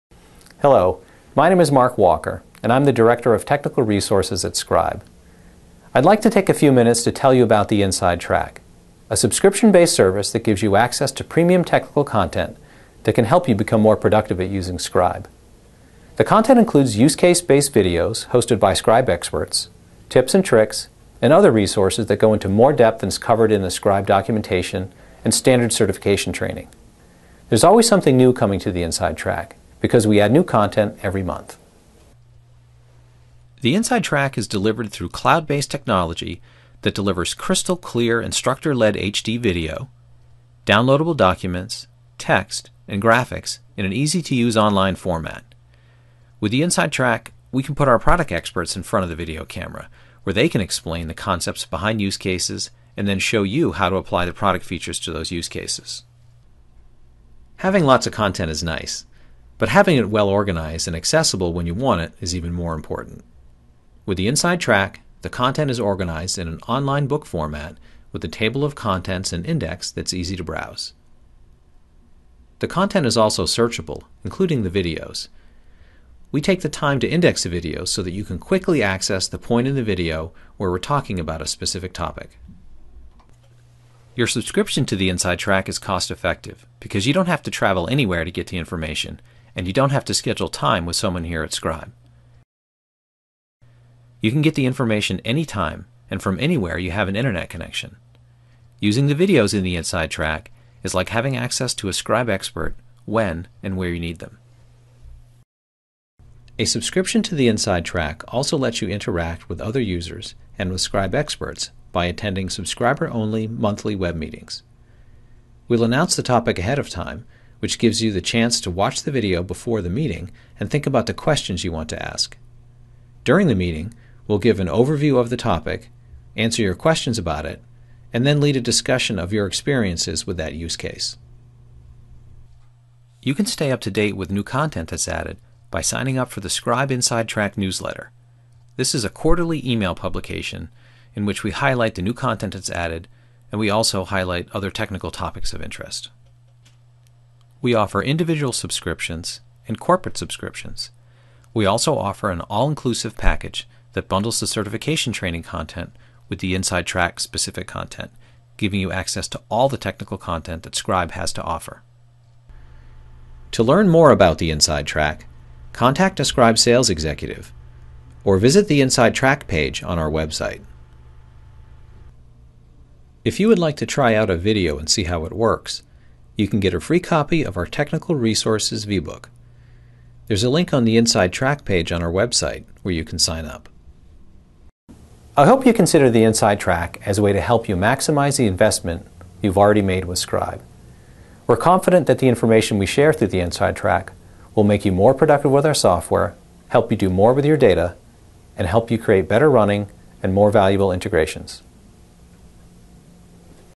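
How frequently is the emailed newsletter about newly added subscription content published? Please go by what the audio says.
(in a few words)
Quarterly.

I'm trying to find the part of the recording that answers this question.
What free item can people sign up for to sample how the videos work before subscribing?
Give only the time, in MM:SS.
02:57.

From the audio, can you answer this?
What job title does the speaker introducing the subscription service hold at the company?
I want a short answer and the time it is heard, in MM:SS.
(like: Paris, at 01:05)
Director of Technical Resources, at 00:02.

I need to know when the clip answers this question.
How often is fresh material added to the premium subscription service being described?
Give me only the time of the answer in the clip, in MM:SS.
00:31.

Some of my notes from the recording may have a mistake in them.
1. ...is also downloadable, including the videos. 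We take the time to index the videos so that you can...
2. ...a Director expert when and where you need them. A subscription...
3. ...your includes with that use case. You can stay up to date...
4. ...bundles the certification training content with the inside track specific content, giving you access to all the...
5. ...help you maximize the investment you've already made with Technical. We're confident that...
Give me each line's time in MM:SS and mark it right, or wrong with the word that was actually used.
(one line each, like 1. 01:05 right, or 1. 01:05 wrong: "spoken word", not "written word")
1. 01:13 wrong: "searchable", not "downloadable"
2. 01:41 wrong: "Scribe", not "Director"
3. 02:09 wrong: "experiences", not "includes"
4. 02:34 right
5. 03:07 wrong: "Scribe", not "Technical".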